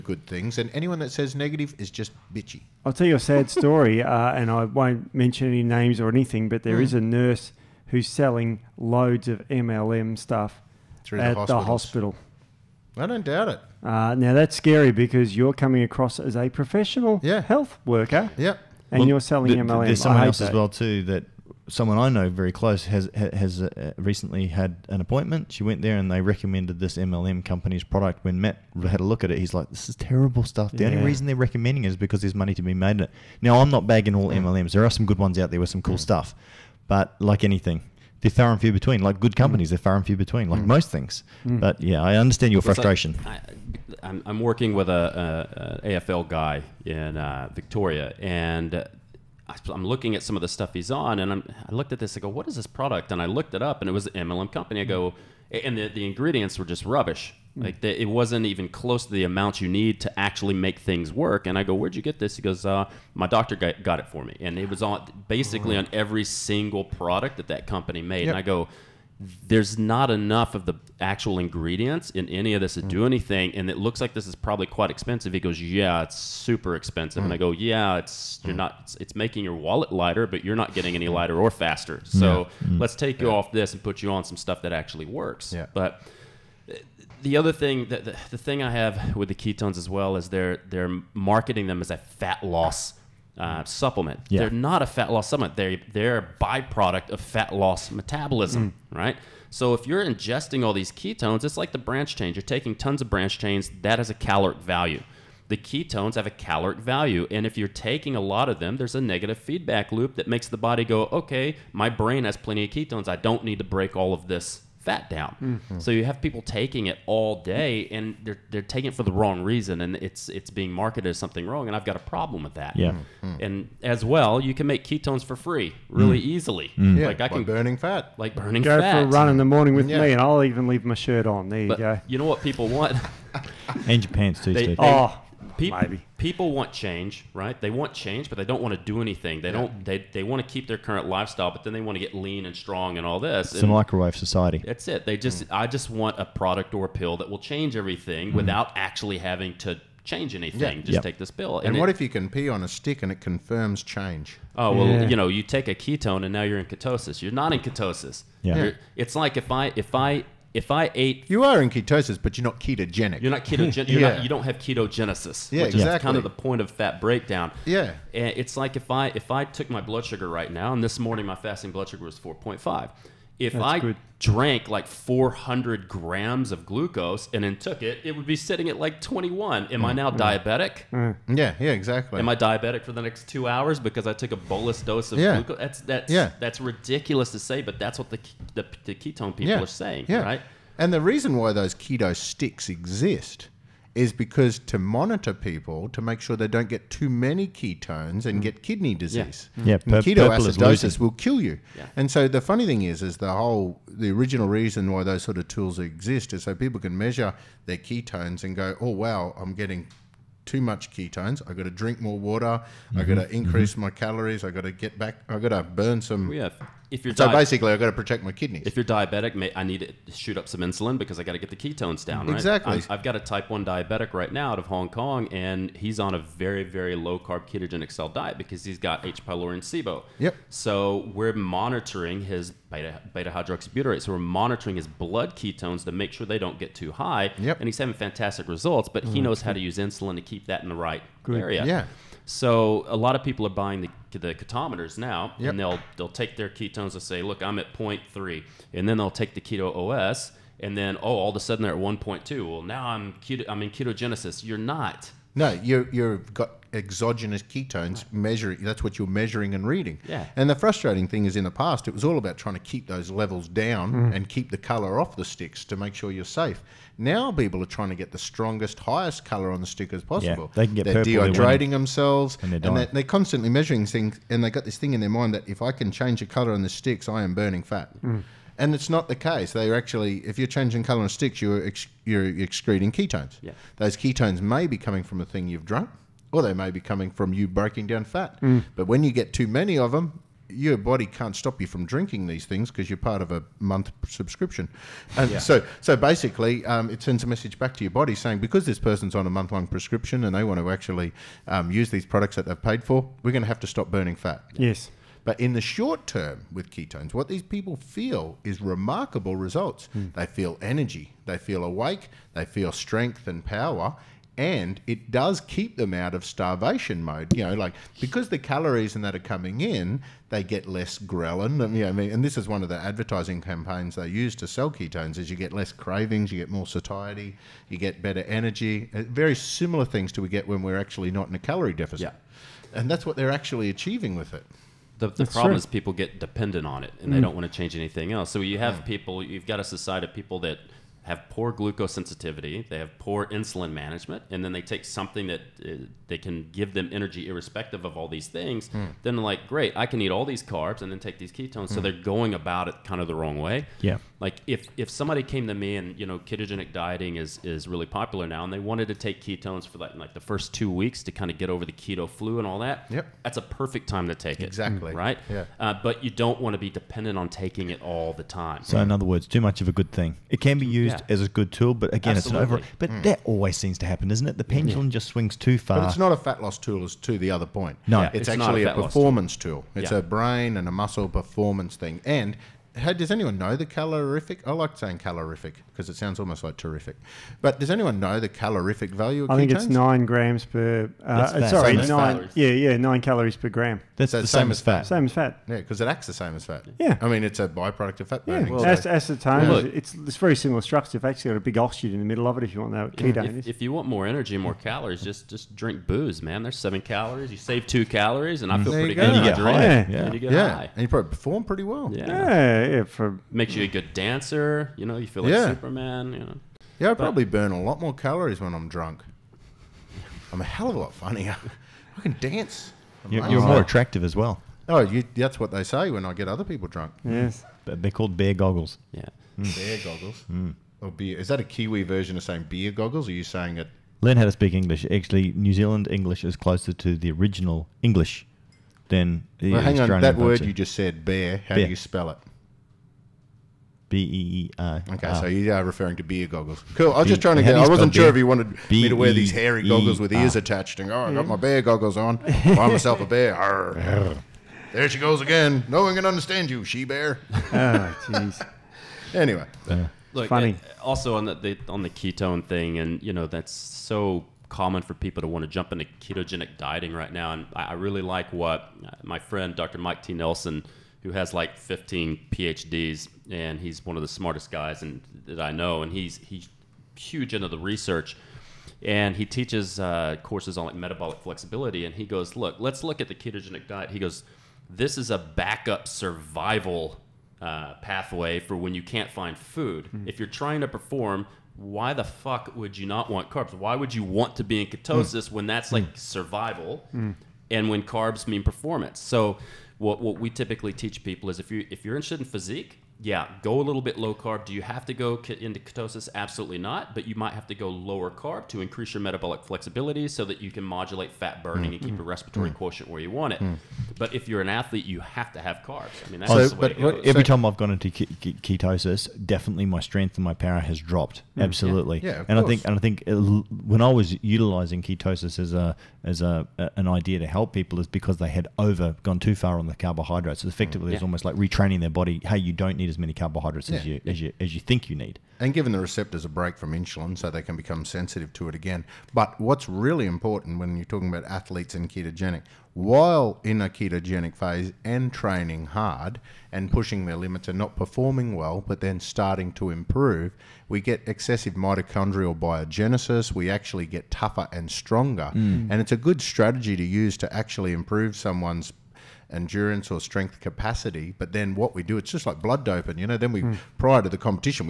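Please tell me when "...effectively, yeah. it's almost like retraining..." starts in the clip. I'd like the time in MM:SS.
08:50.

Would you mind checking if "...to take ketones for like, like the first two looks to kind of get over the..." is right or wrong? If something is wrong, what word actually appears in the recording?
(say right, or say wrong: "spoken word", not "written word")
wrong: "weeks", not "looks".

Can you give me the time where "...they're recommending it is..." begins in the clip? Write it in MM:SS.
00:31.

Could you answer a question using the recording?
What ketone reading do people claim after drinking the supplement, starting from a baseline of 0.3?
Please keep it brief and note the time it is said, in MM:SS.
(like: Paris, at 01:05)
1.2, at 04:11.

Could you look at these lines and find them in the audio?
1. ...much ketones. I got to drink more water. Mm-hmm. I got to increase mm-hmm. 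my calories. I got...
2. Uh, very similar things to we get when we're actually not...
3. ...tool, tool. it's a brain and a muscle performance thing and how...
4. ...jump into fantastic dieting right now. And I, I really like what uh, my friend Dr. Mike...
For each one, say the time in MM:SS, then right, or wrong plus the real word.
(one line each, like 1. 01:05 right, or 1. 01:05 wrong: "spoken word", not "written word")
1. 03:30 right
2. 05:28 right
3. 06:19 right
4. 07:45 wrong: "ketogenic", not "fantastic".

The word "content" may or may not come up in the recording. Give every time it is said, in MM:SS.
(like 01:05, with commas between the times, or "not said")
not said.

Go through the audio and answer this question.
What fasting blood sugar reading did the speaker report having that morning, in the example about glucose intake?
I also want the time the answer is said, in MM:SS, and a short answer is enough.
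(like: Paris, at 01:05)
4.5, at 02:52.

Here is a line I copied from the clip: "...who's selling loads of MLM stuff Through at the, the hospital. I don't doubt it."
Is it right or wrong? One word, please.
right.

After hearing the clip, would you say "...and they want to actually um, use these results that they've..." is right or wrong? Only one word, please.
wrong.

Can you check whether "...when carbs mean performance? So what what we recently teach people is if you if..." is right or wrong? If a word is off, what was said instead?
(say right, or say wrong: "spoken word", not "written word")
wrong: "typically", not "recently".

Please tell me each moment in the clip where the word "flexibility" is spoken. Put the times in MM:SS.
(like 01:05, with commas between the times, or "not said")
08:01, 08:29.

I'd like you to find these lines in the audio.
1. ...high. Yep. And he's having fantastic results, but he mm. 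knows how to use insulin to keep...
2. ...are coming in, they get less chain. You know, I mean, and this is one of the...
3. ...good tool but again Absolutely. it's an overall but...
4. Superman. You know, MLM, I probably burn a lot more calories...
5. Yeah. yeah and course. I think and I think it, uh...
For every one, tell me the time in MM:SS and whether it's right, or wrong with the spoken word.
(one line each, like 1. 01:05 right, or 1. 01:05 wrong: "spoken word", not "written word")
1. 03:56 right
2. 05:19 wrong: "ghrelin", not "chain"
3. 06:11 right
4. 06:55 wrong: "Yeah", not "MLM"
5. 08:41 right.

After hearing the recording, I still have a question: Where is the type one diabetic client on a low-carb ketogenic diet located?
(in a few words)
Hong Kong.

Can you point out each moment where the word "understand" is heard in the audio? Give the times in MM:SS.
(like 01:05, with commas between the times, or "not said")
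00:42, 07:36.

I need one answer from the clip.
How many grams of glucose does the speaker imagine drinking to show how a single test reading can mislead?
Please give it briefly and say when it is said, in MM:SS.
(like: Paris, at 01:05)
400, at 02:54.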